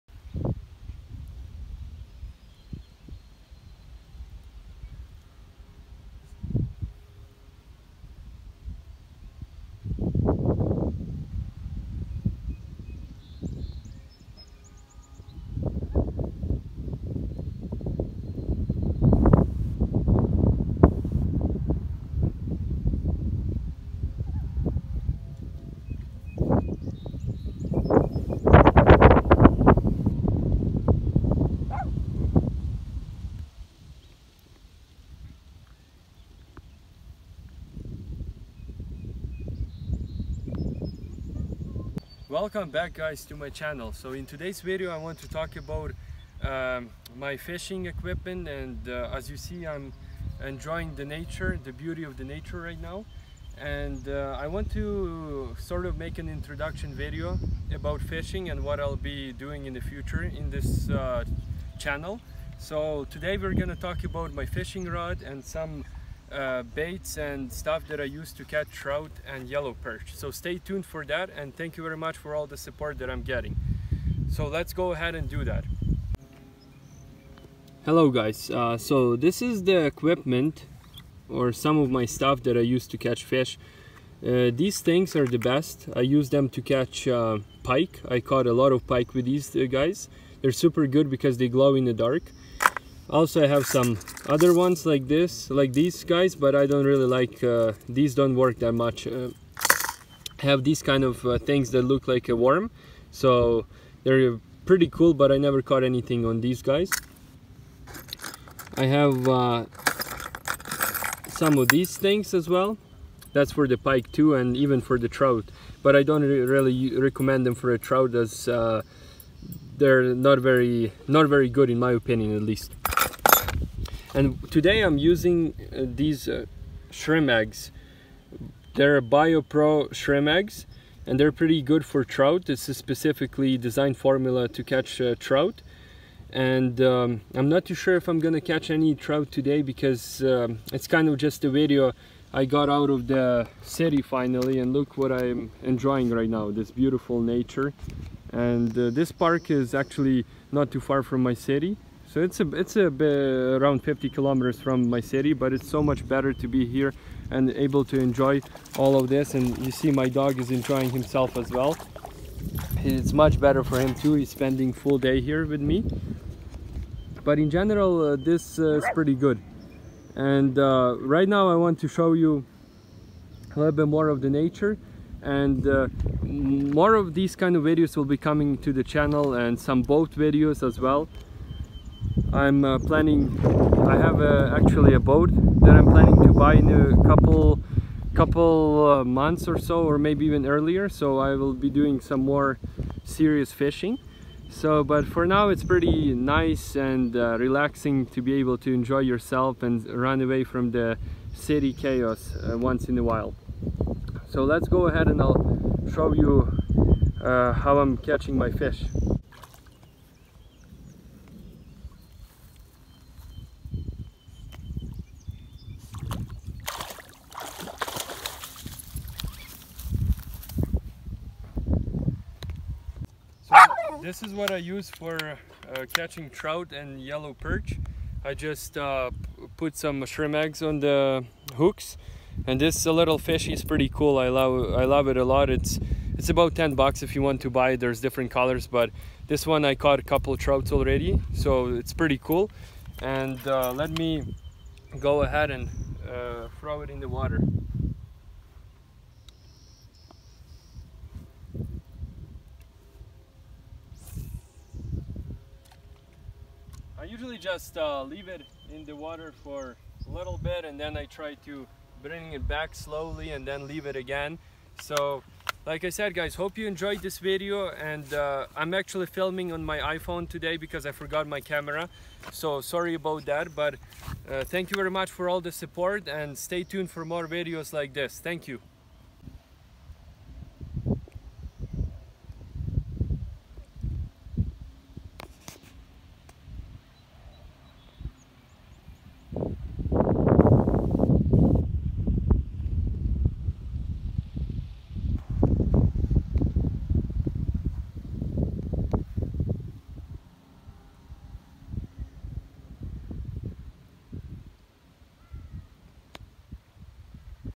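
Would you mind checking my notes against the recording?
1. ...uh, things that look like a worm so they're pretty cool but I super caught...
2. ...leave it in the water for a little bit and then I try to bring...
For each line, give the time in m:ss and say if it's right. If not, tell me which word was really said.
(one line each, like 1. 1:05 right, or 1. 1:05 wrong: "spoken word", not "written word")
1. 1:41 wrong: "never", not "super"
2. 4:18 right.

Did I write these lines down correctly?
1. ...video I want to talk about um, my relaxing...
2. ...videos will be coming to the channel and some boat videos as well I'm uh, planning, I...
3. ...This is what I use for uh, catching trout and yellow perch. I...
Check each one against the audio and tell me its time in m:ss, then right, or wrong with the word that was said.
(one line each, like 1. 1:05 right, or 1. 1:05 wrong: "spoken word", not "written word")
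1. 0:44 wrong: "fishing", not "relaxing"
2. 2:57 right
3. 3:44 right.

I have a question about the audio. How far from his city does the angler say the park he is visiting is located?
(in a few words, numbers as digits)
50 kilometers.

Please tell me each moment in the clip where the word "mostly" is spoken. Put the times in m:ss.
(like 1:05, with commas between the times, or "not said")
not said.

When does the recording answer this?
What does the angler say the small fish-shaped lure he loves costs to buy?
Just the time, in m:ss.
3:56.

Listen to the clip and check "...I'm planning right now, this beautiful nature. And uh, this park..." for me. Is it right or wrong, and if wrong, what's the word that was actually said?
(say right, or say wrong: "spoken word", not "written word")
wrong: "enjoying", not "planning".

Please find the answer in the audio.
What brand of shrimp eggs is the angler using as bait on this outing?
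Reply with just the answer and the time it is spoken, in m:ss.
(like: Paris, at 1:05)
BioPro, at 2:09.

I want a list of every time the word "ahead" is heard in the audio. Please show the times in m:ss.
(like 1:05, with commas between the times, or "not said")
1:14, 3:24, 4:05.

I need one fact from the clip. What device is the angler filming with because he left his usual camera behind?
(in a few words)
iPhone.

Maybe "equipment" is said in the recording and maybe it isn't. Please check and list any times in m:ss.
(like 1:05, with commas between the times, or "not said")
0:47, 1:19.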